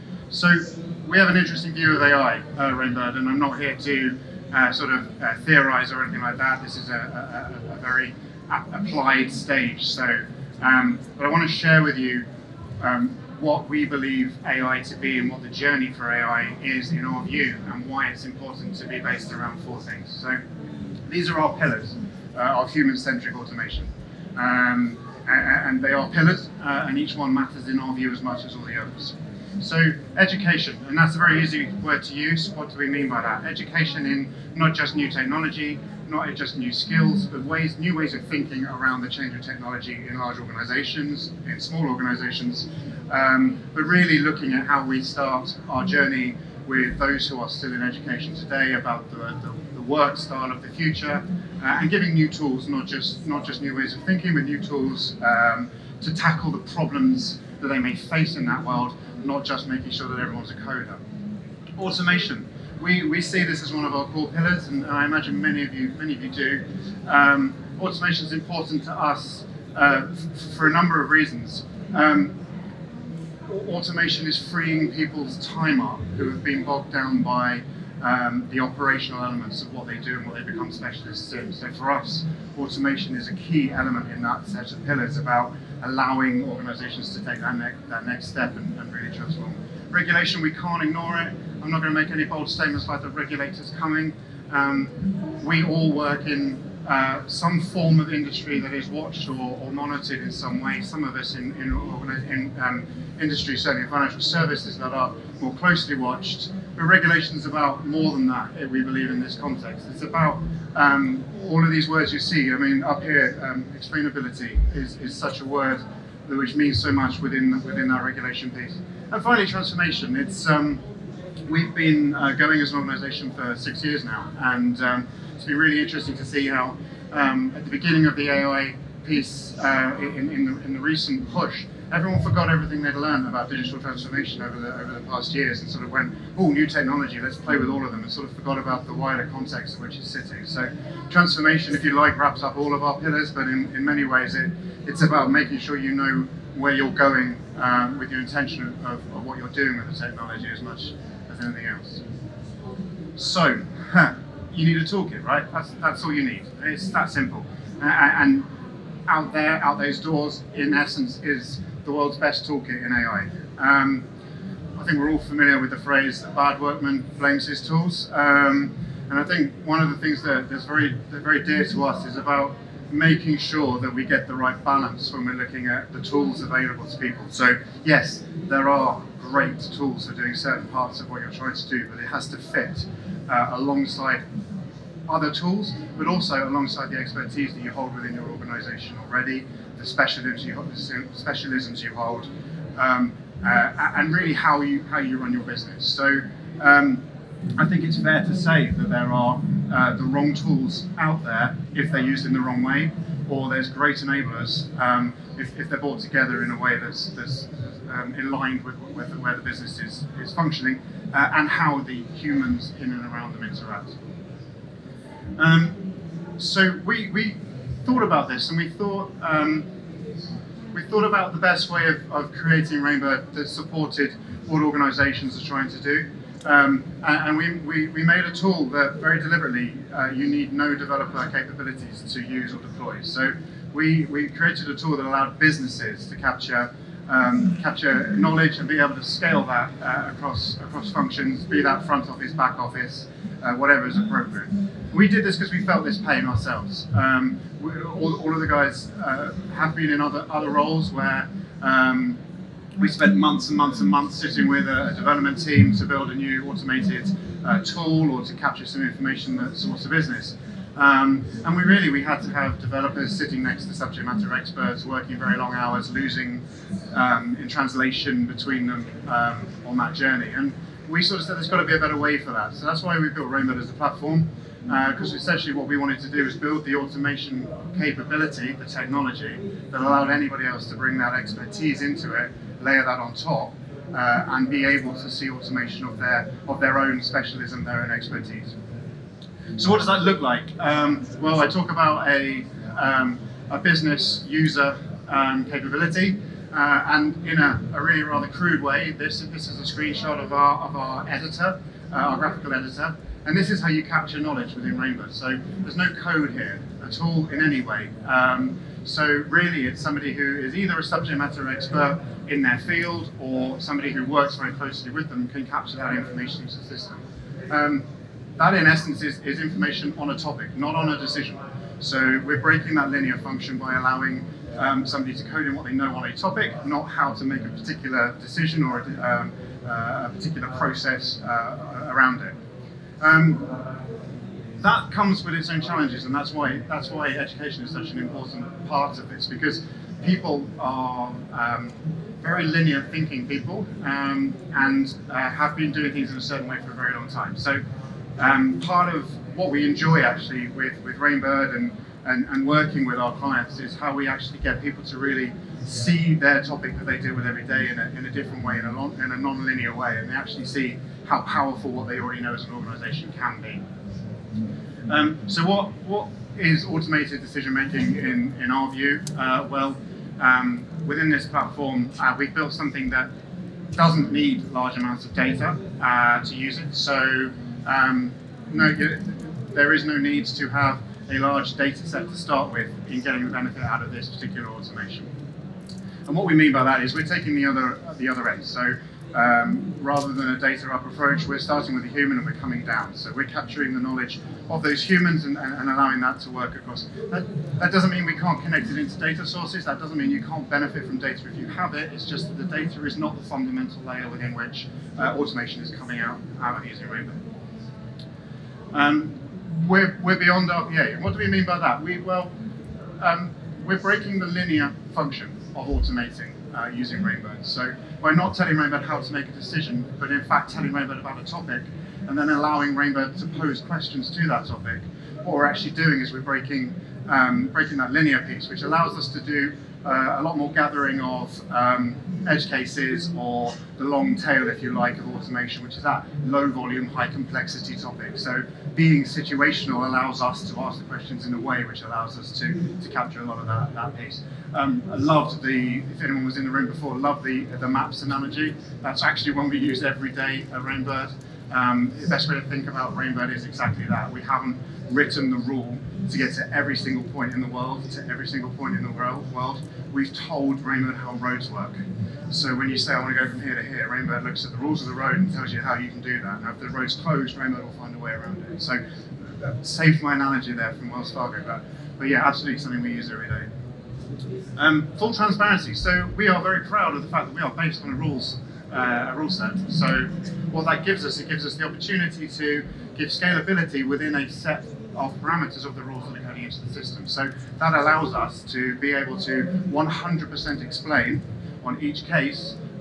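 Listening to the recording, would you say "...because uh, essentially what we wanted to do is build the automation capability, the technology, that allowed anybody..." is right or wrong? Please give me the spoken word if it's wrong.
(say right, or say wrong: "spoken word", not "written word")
right.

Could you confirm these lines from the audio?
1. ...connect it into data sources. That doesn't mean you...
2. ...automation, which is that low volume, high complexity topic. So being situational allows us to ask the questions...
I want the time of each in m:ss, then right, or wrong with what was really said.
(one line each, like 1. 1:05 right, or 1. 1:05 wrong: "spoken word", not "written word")
1. 6:38 right
2. 7:15 right.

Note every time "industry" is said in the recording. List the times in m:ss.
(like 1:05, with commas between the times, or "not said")
1:38, 1:43.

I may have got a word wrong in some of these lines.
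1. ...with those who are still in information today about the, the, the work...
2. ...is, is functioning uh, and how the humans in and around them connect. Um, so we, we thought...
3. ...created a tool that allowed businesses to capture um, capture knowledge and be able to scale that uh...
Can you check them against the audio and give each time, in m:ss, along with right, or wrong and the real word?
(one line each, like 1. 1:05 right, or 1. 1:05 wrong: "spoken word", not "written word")
1. 0:46 wrong: "education", not "information"
2. 3:29 wrong: "interact", not "connect"
3. 3:54 right.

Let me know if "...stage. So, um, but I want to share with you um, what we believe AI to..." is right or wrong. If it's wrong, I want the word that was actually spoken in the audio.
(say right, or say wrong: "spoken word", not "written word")
right.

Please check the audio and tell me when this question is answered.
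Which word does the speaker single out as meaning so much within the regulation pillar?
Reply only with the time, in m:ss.
1:53.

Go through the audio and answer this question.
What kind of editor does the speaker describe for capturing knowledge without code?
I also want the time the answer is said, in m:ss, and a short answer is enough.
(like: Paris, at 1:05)
Graphical editor, at 5:02.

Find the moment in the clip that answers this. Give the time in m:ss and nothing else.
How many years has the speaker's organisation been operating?
2:03.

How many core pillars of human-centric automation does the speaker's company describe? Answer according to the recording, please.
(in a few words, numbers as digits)
4.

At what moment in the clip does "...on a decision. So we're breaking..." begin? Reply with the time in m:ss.
5:20.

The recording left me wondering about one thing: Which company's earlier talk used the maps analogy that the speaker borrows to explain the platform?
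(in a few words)
Wells Fargo.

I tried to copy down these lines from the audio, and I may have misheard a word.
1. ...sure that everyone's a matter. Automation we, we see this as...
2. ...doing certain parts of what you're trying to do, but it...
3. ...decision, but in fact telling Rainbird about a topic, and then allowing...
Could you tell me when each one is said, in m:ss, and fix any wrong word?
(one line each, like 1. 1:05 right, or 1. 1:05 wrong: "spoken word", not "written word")
1. 0:59 wrong: "coder", not "matter"
2. 3:00 right
3. 6:59 right.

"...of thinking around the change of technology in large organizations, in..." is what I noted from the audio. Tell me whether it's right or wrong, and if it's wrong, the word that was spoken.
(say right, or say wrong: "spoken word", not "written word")
right.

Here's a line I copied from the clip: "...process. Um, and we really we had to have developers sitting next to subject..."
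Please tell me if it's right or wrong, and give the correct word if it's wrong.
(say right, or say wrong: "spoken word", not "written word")
wrong: "business", not "process".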